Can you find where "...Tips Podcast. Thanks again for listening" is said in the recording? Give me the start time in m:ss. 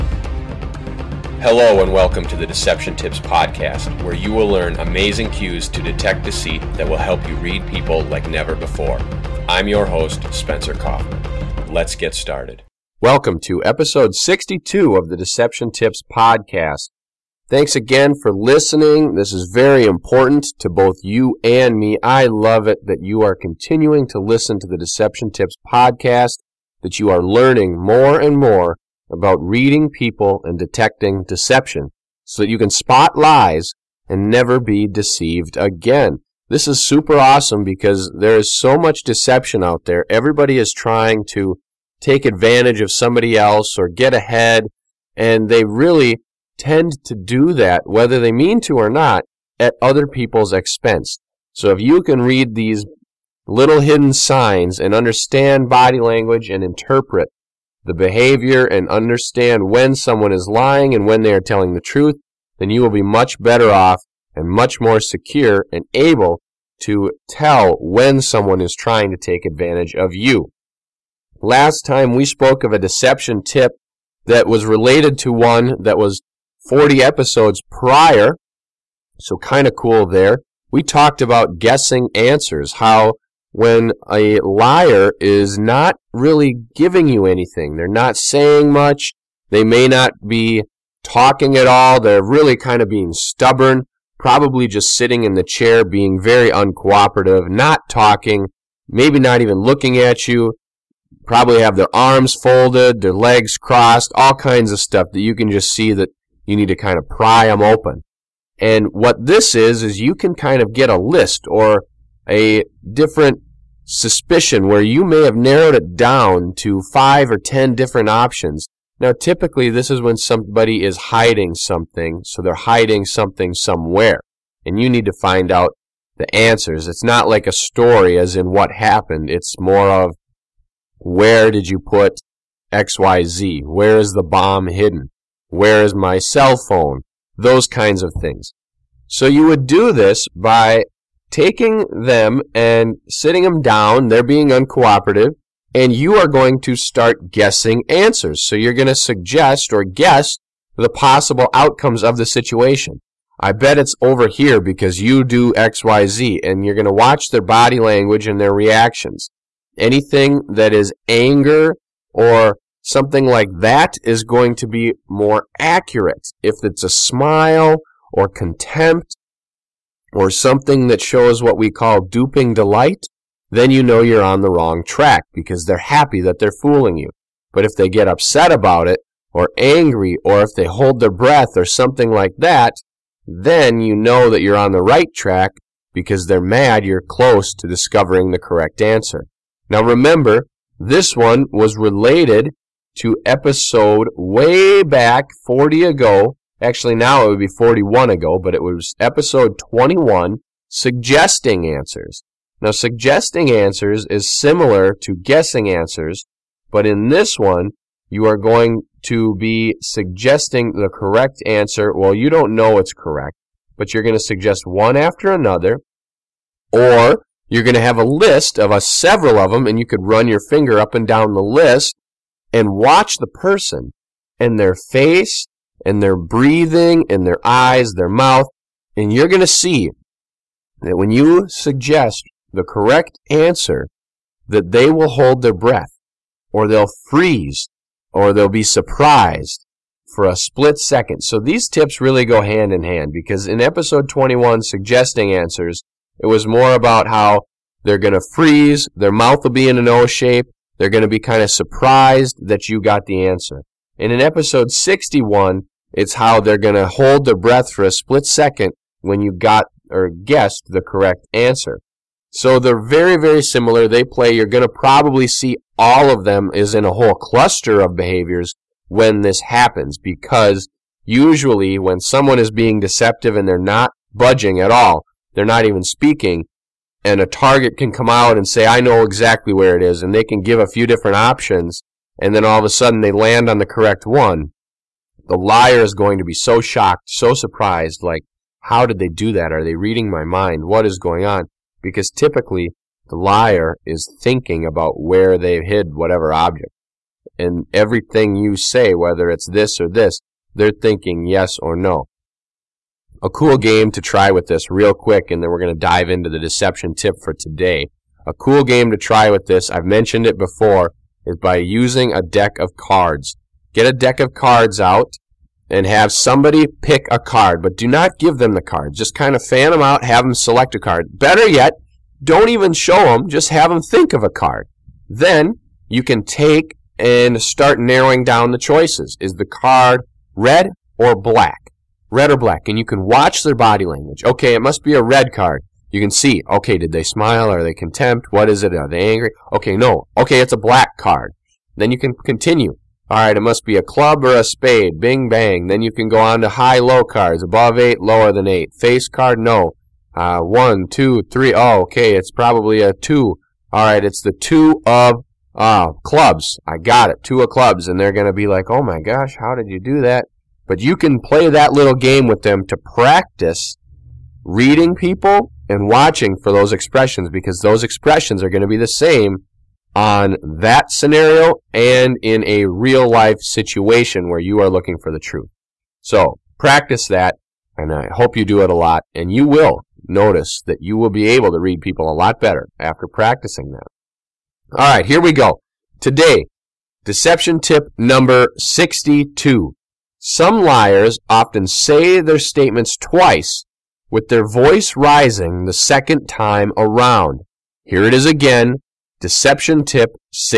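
0:15.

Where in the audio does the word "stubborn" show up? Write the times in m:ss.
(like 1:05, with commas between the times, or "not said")
1:33.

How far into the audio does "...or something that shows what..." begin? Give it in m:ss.
2:50.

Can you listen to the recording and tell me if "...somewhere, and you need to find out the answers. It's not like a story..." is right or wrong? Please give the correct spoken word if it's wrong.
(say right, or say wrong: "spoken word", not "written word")
right.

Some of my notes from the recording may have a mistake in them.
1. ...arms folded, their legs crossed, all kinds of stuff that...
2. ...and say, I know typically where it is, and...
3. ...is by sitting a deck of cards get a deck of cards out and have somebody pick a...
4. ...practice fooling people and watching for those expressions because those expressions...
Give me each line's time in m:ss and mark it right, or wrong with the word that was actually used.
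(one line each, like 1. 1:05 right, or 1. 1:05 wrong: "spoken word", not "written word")
1. 1:41 right
2. 4:38 wrong: "exactly", not "typically"
3. 5:11 wrong: "using", not "sitting"
4. 6:02 wrong: "reading", not "fooling".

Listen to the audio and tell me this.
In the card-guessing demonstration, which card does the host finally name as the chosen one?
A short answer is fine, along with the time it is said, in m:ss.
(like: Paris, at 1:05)
2 of clubs, at 5:57.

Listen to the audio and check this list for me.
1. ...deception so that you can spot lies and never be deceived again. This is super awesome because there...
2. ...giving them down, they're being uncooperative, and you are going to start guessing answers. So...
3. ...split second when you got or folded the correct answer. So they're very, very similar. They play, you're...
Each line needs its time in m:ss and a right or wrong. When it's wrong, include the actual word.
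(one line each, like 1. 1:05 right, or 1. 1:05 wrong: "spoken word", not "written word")
1. 0:31 right
2. 2:23 wrong: "sitting", not "giving"
3. 4:17 wrong: "guessed", not "folded".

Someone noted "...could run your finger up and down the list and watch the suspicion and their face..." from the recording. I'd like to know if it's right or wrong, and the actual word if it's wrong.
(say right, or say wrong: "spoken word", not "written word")
wrong: "person", not "suspicion".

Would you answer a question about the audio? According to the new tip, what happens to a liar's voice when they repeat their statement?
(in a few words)
rising.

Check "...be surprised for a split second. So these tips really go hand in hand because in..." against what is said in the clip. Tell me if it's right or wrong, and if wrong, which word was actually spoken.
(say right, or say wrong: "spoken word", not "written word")
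right.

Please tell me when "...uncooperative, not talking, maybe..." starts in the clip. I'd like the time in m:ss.
1:36.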